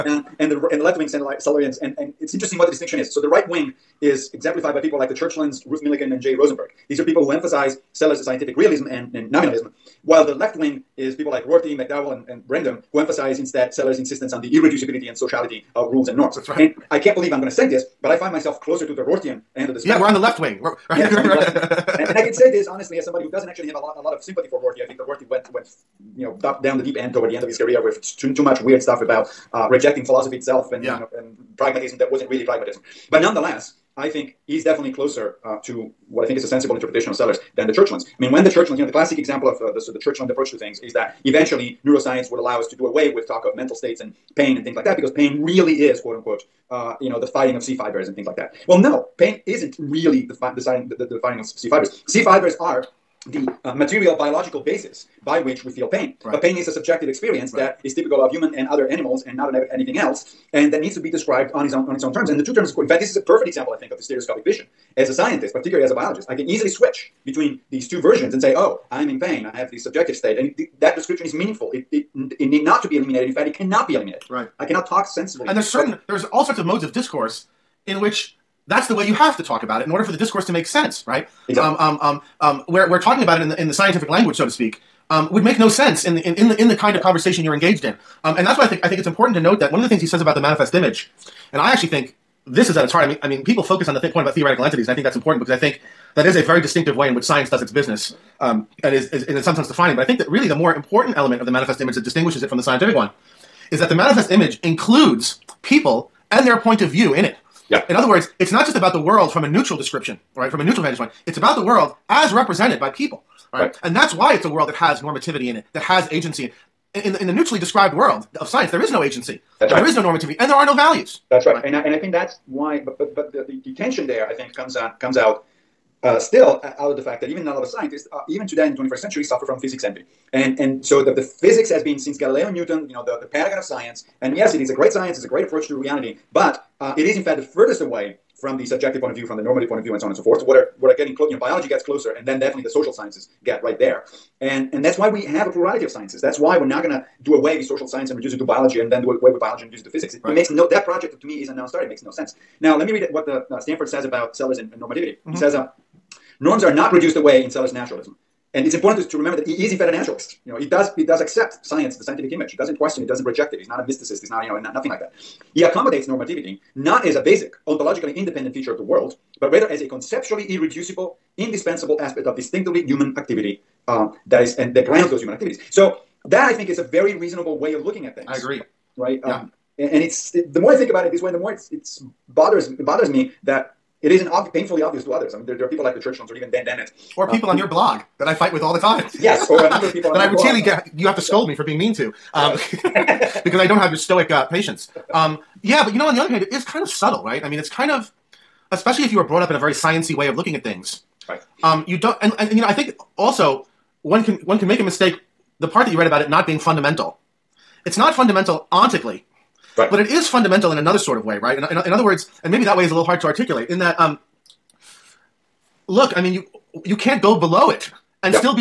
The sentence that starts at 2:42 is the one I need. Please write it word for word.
He doesn't question it, doesn't reject it.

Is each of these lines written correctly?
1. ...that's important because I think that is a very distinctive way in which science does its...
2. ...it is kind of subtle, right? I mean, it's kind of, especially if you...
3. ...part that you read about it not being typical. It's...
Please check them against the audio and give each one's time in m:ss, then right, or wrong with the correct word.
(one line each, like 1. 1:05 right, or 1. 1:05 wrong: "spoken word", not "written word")
1. 1:35 right
2. 3:16 right
3. 3:25 wrong: "fundamental", not "typical".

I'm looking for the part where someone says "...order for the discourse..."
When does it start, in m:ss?
1:19.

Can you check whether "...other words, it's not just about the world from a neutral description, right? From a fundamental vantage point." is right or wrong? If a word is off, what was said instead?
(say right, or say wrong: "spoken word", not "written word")
wrong: "neutral", not "fundamental".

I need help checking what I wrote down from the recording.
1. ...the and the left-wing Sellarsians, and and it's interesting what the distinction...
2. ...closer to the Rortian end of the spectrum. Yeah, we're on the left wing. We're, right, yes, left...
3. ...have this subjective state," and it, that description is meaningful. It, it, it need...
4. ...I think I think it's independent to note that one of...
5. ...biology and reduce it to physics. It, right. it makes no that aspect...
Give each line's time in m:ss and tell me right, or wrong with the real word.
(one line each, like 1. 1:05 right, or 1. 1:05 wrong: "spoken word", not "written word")
1. 0:00 right
2. 0:18 right
3. 1:09 right
4. 1:28 wrong: "important", not "independent"
5. 2:29 wrong: "project", not "aspect".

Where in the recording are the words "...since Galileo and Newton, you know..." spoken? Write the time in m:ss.
2:11.